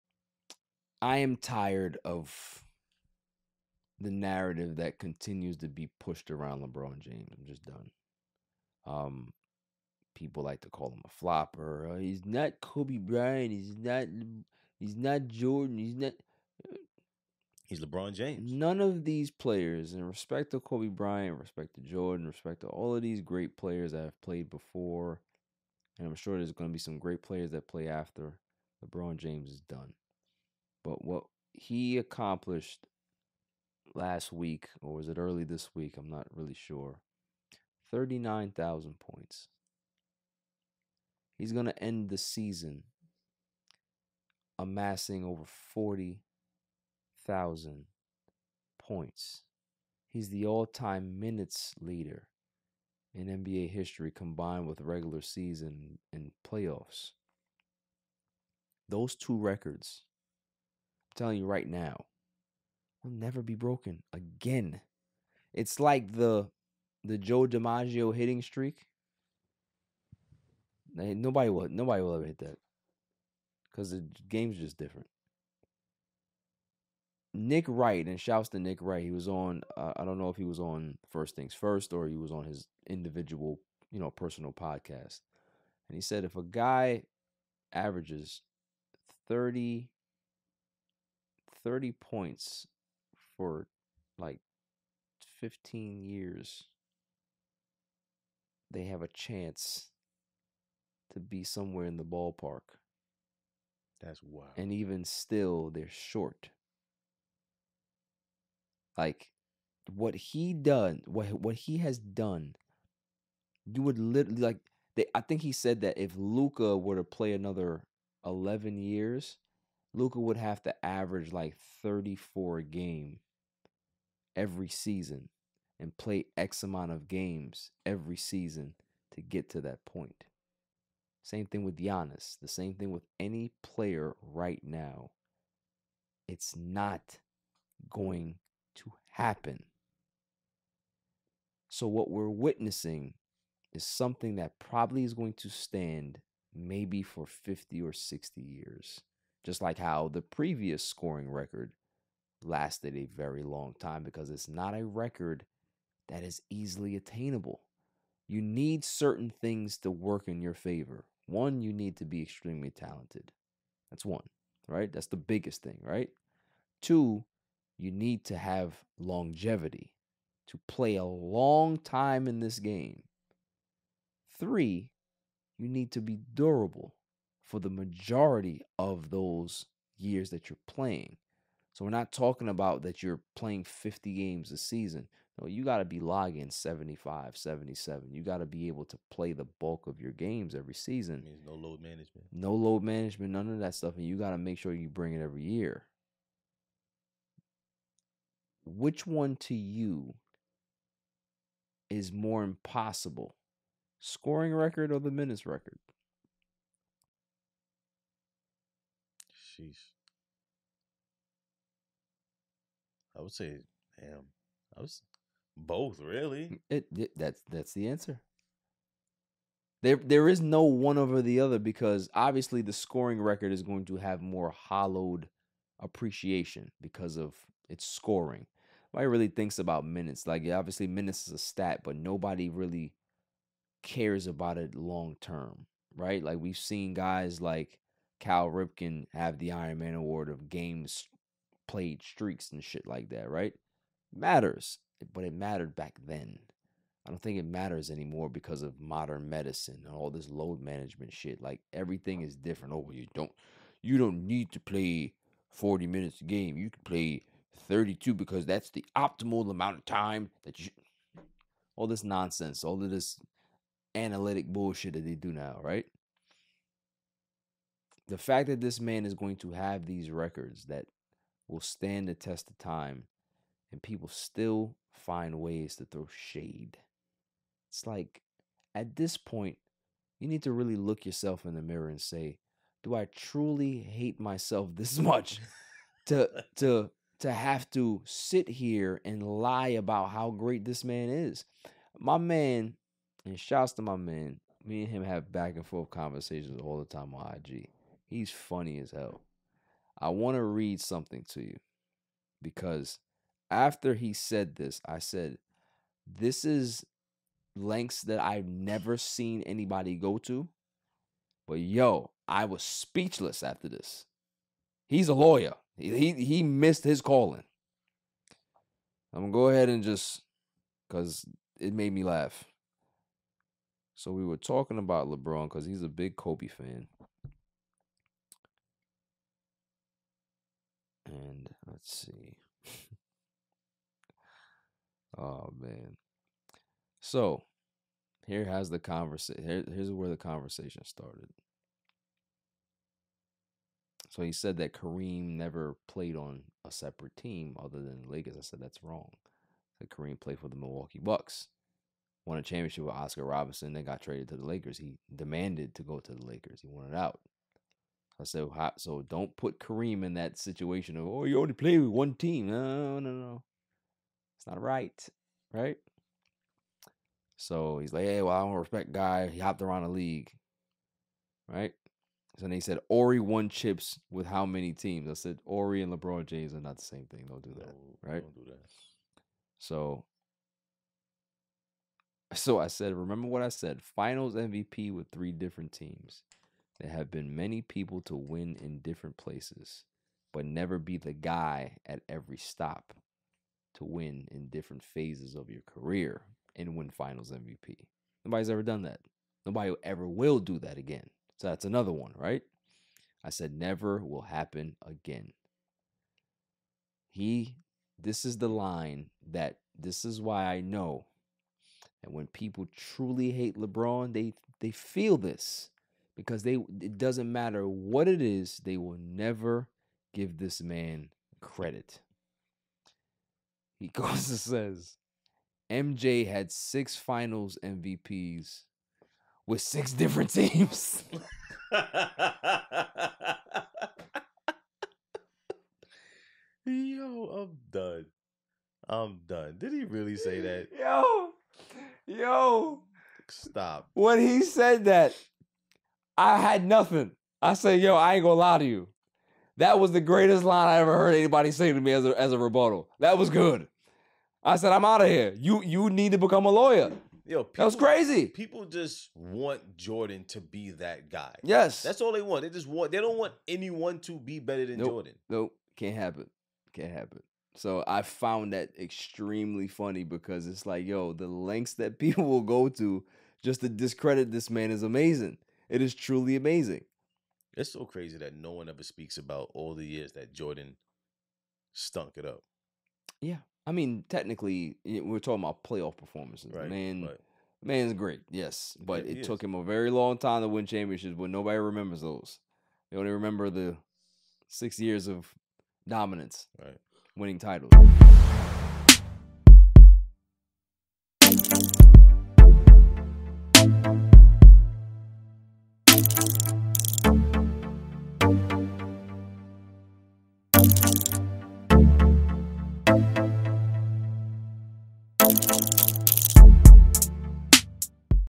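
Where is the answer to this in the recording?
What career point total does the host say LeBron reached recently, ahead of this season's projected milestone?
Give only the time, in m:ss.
0:37.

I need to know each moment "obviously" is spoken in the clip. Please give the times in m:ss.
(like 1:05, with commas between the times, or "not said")
3:42, 3:50.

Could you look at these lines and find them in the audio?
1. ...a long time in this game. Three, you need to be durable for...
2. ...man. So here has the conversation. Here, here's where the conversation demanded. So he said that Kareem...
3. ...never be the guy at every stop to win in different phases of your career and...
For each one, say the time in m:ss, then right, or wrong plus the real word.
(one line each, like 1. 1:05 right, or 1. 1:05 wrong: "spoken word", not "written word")
1. 2:50 right
2. 5:35 wrong: "started", not "demanded"
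3. 6:30 right.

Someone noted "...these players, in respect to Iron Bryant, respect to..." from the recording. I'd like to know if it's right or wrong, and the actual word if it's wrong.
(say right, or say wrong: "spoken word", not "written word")
wrong: "Kobe", not "Iron".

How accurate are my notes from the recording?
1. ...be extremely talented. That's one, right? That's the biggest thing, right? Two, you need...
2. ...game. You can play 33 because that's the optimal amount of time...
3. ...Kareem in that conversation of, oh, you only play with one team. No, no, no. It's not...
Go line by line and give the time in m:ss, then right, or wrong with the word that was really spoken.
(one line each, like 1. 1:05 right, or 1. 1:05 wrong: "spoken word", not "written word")
1. 2:42 right
2. 4:16 wrong: "32", not "33"
3. 5:59 wrong: "situation", not "conversation".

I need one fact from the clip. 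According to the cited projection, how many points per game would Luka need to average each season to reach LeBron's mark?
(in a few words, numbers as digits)
34.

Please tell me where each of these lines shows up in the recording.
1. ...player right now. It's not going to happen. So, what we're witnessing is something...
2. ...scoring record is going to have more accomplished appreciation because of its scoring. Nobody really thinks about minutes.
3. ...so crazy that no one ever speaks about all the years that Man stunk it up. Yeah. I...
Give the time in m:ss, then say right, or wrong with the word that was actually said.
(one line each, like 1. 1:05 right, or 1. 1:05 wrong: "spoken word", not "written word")
1. 2:13 right
2. 3:42 wrong: "hollowed", not "accomplished"
3. 7:57 wrong: "Jordan", not "Man".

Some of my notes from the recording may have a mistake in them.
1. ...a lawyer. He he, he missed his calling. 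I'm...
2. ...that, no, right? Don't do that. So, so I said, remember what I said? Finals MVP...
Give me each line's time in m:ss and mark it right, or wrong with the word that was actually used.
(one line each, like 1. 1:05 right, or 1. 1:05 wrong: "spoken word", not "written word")
1. 5:15 right
2. 6:17 right.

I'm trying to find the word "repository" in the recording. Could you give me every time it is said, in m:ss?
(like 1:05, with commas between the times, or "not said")
not said.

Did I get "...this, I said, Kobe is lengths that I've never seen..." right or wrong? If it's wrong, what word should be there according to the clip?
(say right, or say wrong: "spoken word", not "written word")
wrong: "This", not "Kobe".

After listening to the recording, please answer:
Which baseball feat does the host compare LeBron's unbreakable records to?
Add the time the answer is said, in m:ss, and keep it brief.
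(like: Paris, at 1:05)
Joe DiMaggio hitting streak, at 1:07.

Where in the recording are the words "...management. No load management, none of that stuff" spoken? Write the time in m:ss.
3:11.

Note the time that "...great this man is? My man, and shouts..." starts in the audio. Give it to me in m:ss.
4:50.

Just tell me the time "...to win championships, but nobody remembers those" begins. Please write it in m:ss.
8:10.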